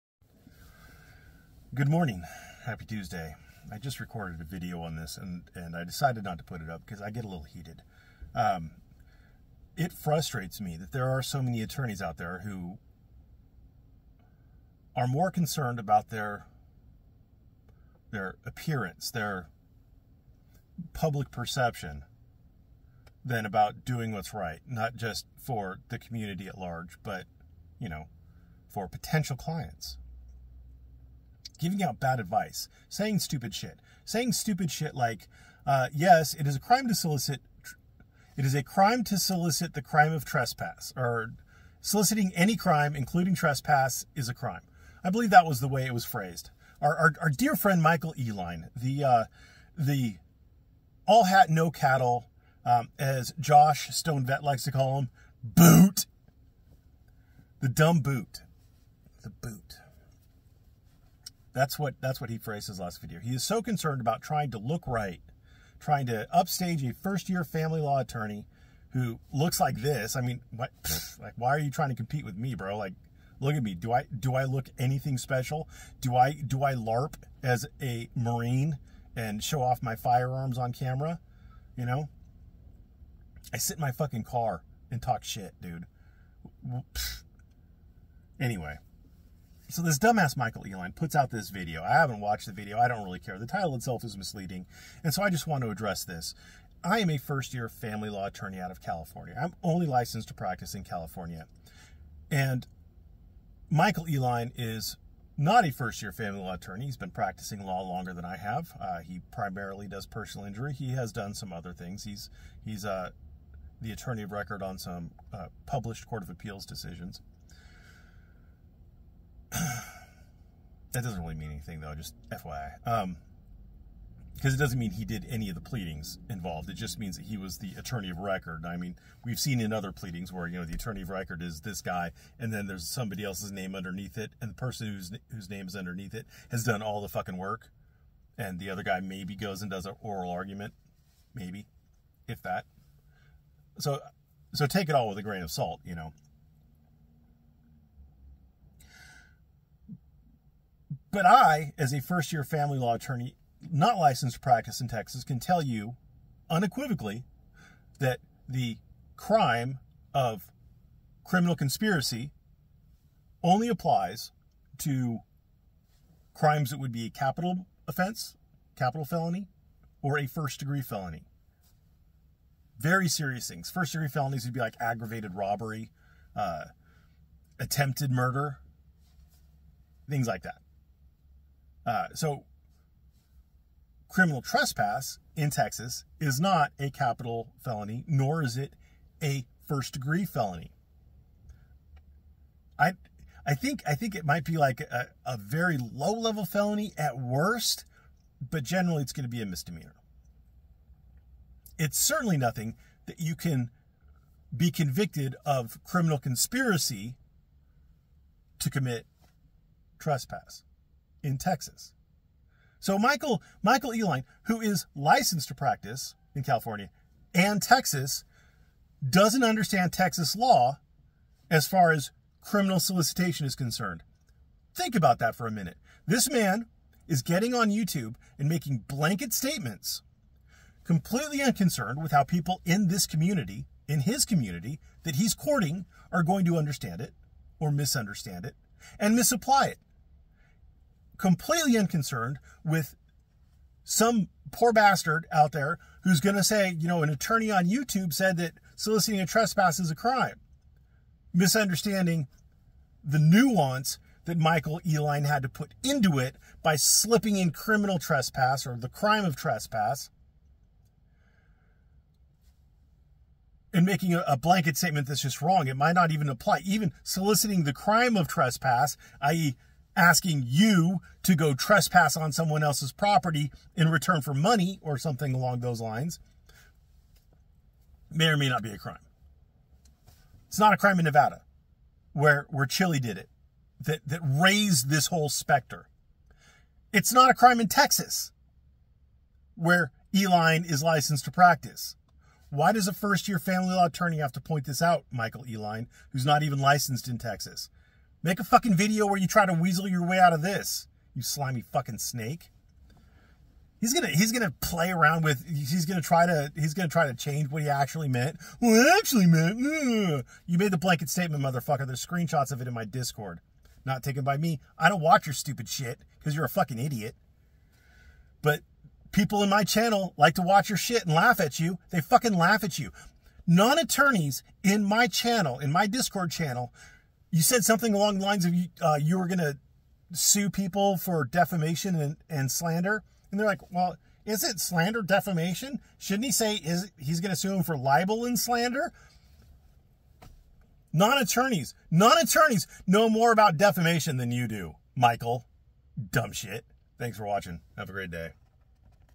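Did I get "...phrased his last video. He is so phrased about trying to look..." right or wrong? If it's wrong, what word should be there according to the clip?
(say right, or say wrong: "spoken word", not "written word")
wrong: "concerned", not "phrased".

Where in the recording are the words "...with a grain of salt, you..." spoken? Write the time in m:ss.
2:25.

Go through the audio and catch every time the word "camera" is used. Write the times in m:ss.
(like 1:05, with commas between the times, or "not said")
1:20.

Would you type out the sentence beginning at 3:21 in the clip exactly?
It's certainly nothing that you can be convicted of criminal conspiracy to commit trespass in Texas.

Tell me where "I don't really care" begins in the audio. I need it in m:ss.
1:32.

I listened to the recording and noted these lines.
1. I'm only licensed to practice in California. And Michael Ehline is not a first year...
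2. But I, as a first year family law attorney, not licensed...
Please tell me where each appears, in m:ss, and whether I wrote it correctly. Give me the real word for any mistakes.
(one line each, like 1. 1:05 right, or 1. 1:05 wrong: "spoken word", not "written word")
1. 1:39 right
2. 2:31 right.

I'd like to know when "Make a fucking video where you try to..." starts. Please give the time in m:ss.
4:58.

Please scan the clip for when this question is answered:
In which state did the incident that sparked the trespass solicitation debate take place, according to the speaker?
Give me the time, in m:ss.
4:41.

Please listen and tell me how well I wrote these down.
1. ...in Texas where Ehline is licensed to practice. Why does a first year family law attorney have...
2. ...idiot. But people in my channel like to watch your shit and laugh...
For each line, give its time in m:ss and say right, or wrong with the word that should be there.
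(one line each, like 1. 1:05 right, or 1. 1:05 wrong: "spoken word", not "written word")
1. 4:47 right
2. 5:16 right.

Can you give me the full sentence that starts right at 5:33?
And they're like, well, is it slander defamation?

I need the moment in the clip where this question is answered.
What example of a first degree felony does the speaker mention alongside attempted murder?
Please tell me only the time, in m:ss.
2:54.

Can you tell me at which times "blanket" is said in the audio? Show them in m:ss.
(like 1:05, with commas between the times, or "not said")
3:48, 4:24, 5:10.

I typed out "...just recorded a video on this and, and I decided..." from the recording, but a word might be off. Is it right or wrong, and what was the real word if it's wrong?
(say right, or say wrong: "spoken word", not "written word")
right.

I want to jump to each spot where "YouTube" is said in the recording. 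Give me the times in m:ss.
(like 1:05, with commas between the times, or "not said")
3:47, 4:07.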